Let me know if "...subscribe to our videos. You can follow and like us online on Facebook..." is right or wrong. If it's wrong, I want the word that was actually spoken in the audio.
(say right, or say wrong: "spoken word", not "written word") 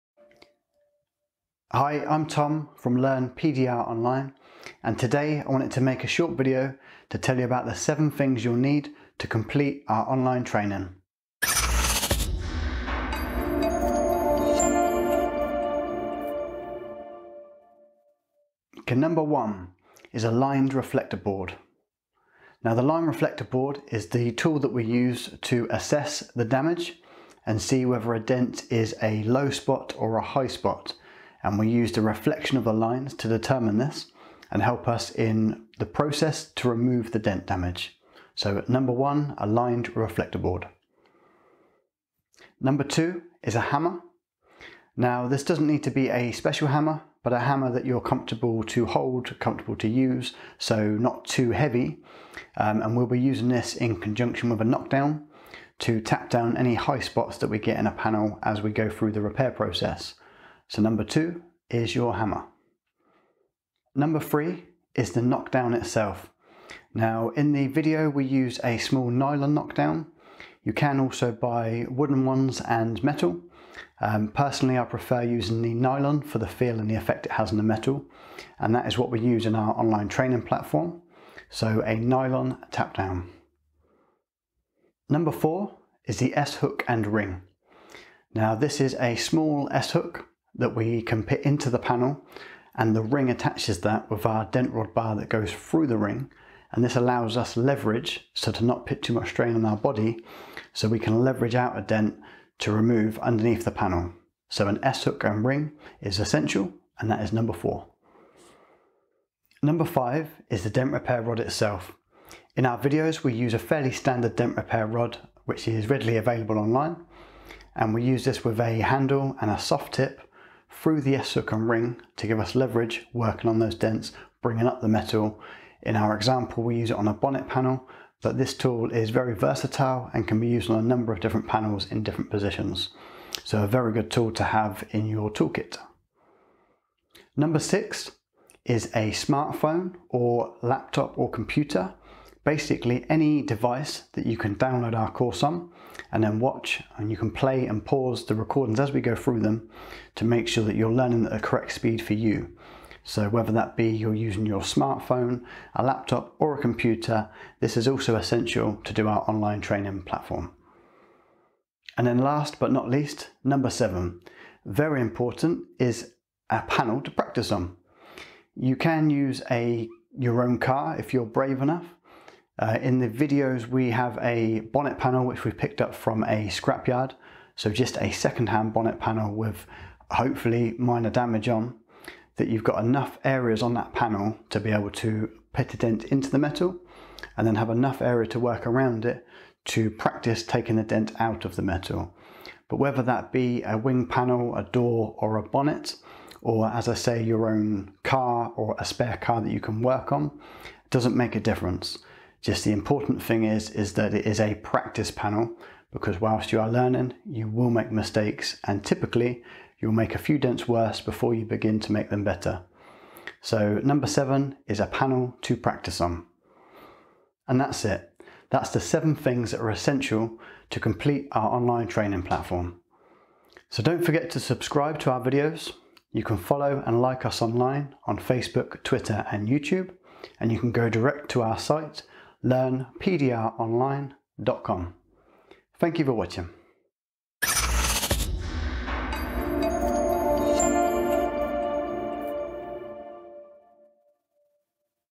right.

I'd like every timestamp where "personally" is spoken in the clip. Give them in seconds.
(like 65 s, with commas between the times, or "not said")
74 s.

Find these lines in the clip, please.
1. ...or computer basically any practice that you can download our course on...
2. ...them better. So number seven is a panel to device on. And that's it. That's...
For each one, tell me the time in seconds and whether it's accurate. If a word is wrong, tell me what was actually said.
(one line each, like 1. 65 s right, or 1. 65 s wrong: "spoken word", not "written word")
1. 141 s wrong: "device", not "practice"
2. 212 s wrong: "practice", not "device".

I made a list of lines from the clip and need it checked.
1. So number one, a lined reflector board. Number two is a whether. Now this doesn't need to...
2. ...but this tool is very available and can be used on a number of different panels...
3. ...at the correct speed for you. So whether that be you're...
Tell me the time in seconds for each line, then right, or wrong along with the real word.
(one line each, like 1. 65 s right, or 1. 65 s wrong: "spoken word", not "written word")
1. 38 s wrong: "hammer", not "whether"
2. 128 s wrong: "versatile", not "available"
3. 151 s right.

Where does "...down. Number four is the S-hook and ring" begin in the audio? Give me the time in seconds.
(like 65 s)
82 s.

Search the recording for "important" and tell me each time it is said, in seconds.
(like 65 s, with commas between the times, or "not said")
165 s, 202 s.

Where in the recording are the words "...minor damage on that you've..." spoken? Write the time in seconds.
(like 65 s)
180 s.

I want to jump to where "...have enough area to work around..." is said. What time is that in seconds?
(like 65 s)
187 s.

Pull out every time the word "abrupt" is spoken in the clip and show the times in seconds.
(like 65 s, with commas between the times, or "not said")
not said.